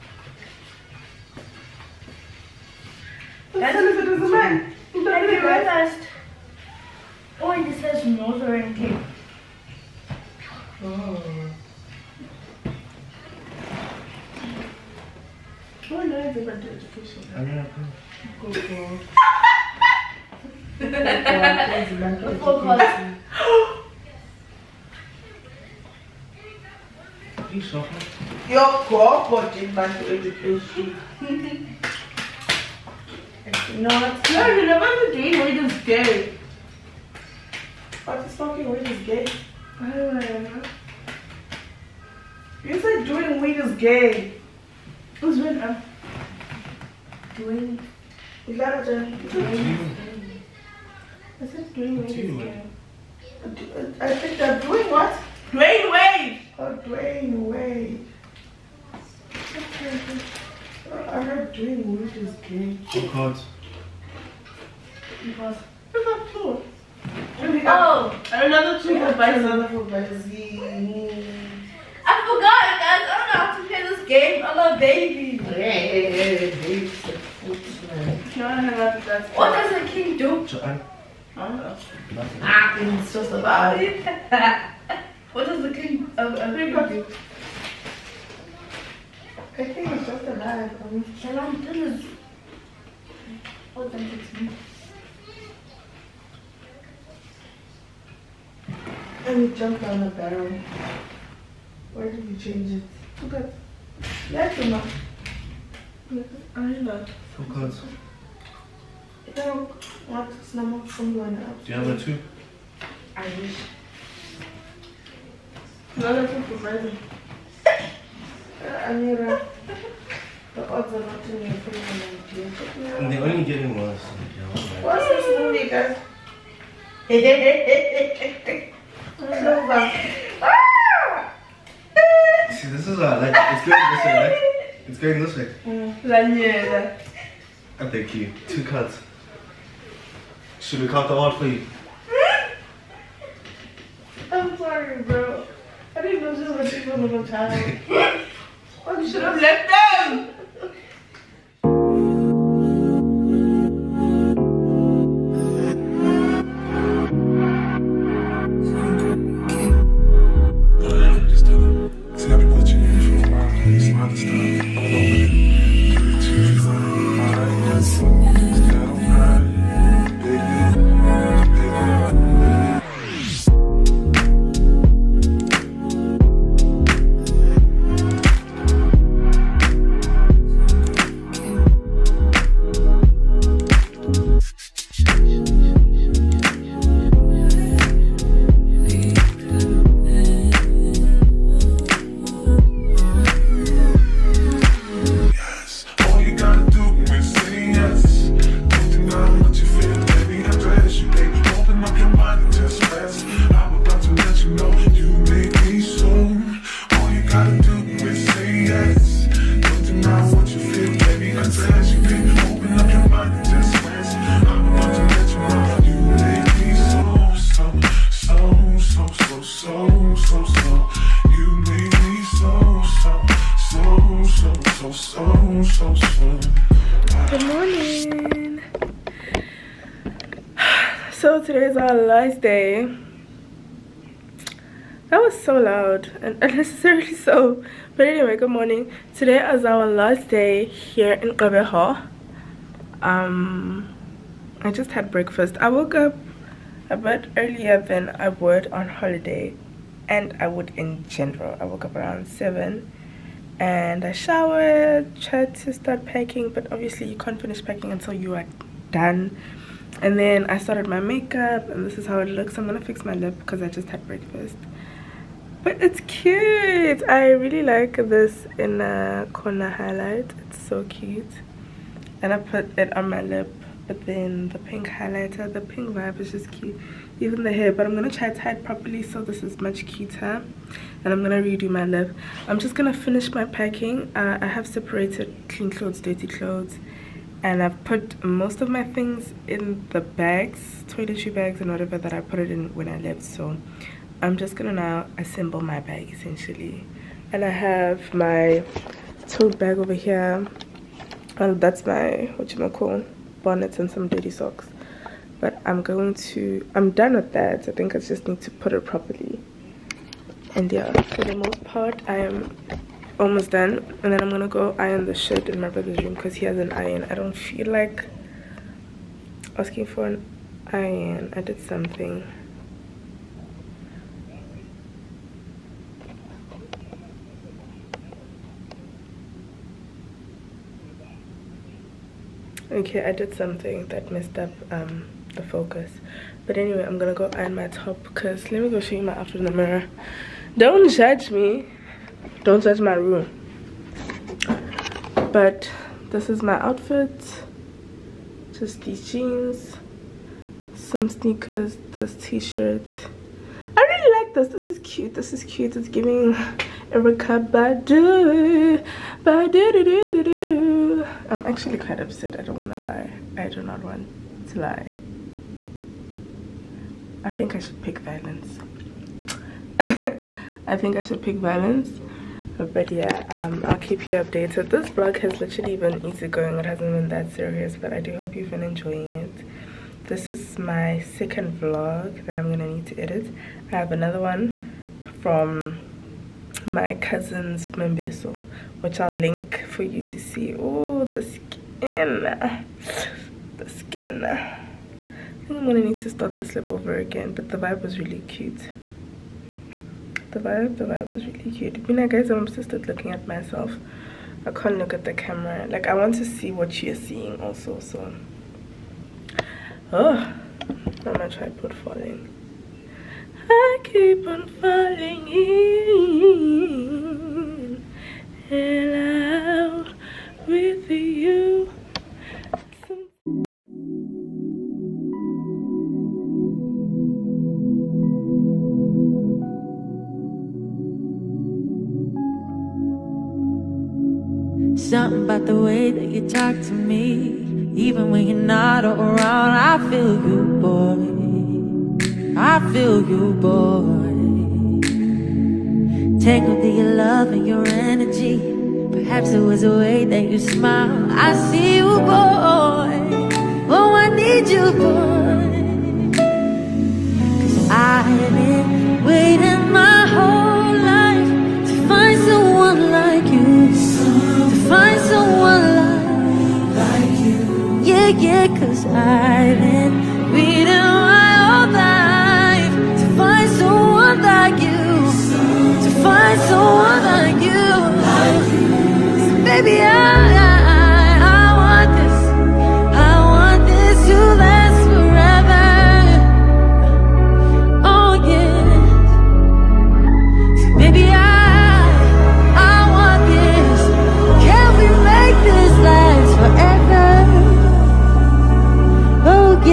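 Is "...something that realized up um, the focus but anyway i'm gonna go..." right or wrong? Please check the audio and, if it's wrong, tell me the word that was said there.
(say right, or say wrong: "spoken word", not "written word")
wrong: "messed", not "realized".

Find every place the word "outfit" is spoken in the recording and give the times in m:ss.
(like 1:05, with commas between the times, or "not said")
5:39, 5:46.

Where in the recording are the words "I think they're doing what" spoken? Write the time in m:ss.
0:54.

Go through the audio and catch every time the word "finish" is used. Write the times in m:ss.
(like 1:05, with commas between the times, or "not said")
4:17, 4:42.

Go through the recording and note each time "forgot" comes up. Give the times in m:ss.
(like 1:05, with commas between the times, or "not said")
0:16, 1:07.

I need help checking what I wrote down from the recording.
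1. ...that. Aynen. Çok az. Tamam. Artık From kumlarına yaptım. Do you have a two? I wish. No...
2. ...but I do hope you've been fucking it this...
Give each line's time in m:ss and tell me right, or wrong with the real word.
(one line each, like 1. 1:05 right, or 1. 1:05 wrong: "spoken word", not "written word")
1. 1:44 right
2. 6:17 wrong: "enjoying", not "fucking".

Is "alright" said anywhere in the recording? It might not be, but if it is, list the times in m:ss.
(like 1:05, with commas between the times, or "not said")
not said.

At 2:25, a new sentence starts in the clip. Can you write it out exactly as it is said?
I didn't know this was a little time.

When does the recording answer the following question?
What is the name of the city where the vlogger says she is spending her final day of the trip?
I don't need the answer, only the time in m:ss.
4:01.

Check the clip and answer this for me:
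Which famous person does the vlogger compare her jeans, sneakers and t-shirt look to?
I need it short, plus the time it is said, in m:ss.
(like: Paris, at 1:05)
Erykah Badu, at 5:56.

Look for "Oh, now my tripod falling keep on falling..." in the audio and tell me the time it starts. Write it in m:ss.
6:49.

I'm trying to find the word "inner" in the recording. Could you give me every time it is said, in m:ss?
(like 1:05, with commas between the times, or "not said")
4:28.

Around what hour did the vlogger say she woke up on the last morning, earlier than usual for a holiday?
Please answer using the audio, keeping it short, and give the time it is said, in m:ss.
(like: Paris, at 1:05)
7, at 4:12.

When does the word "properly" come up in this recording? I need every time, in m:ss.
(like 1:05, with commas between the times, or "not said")
4:38, 5:08.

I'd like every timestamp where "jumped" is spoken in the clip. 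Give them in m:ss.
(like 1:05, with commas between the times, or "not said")
1:39.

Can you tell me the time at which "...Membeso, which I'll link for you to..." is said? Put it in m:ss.
6:27.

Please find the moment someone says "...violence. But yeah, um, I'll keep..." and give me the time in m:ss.
6:11.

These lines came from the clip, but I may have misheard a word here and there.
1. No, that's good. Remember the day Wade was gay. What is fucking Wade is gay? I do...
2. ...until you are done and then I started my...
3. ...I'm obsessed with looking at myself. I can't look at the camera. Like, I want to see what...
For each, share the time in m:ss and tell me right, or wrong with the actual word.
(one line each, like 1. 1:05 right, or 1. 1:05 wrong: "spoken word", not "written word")
1. 0:33 right
2. 4:17 right
3. 6:42 right.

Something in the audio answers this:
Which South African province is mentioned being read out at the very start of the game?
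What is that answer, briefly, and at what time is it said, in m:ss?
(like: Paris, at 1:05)
Northern Cape, at 0:08.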